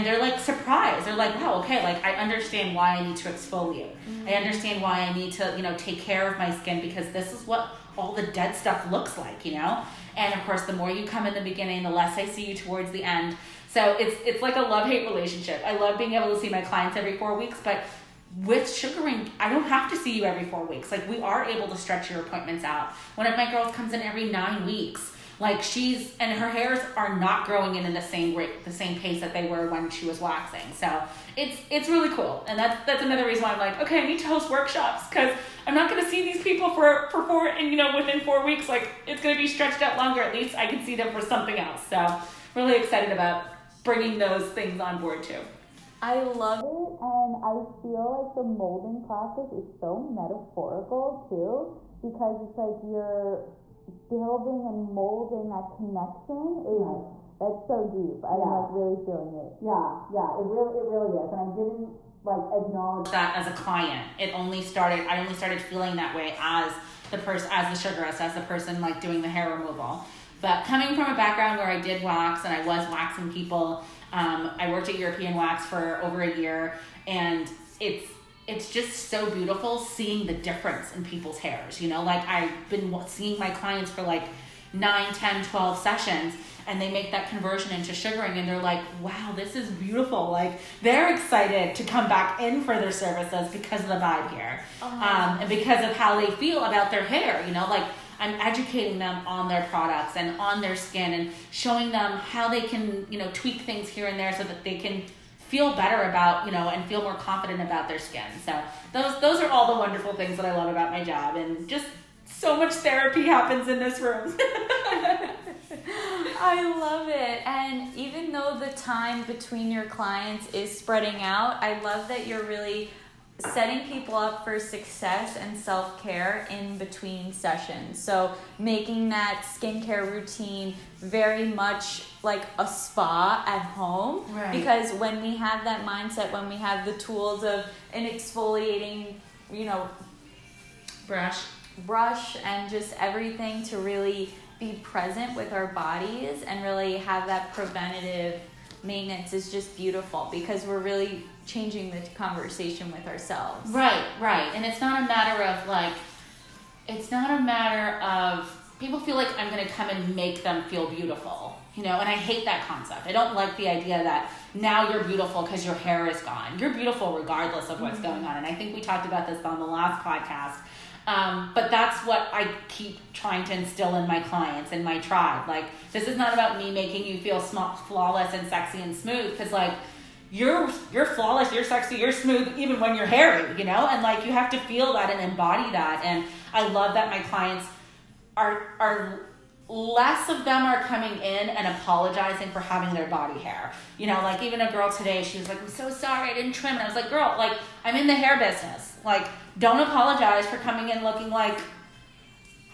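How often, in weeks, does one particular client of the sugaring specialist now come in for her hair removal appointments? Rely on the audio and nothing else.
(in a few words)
9.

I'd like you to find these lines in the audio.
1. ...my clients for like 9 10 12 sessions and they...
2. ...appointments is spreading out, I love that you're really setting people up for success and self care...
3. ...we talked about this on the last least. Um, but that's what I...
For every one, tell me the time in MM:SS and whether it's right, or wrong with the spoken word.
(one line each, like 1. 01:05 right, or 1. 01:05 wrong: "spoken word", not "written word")
1. 01:23 right
2. 01:59 wrong: "clients", not "appointments"
3. 02:48 wrong: "podcast", not "least".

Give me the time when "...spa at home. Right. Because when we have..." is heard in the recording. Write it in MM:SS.
02:12.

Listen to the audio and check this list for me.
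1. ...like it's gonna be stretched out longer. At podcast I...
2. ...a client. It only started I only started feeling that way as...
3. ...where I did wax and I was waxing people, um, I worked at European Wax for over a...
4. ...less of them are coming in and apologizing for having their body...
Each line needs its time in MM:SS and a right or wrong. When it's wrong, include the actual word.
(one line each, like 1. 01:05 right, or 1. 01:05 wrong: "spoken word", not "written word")
1. 00:38 wrong: "least", not "podcast"
2. 01:03 right
3. 01:11 right
4. 03:09 right.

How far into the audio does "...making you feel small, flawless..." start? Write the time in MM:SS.
02:56.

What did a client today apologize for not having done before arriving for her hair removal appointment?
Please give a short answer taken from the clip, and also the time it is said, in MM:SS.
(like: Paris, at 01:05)
trim, at 03:16.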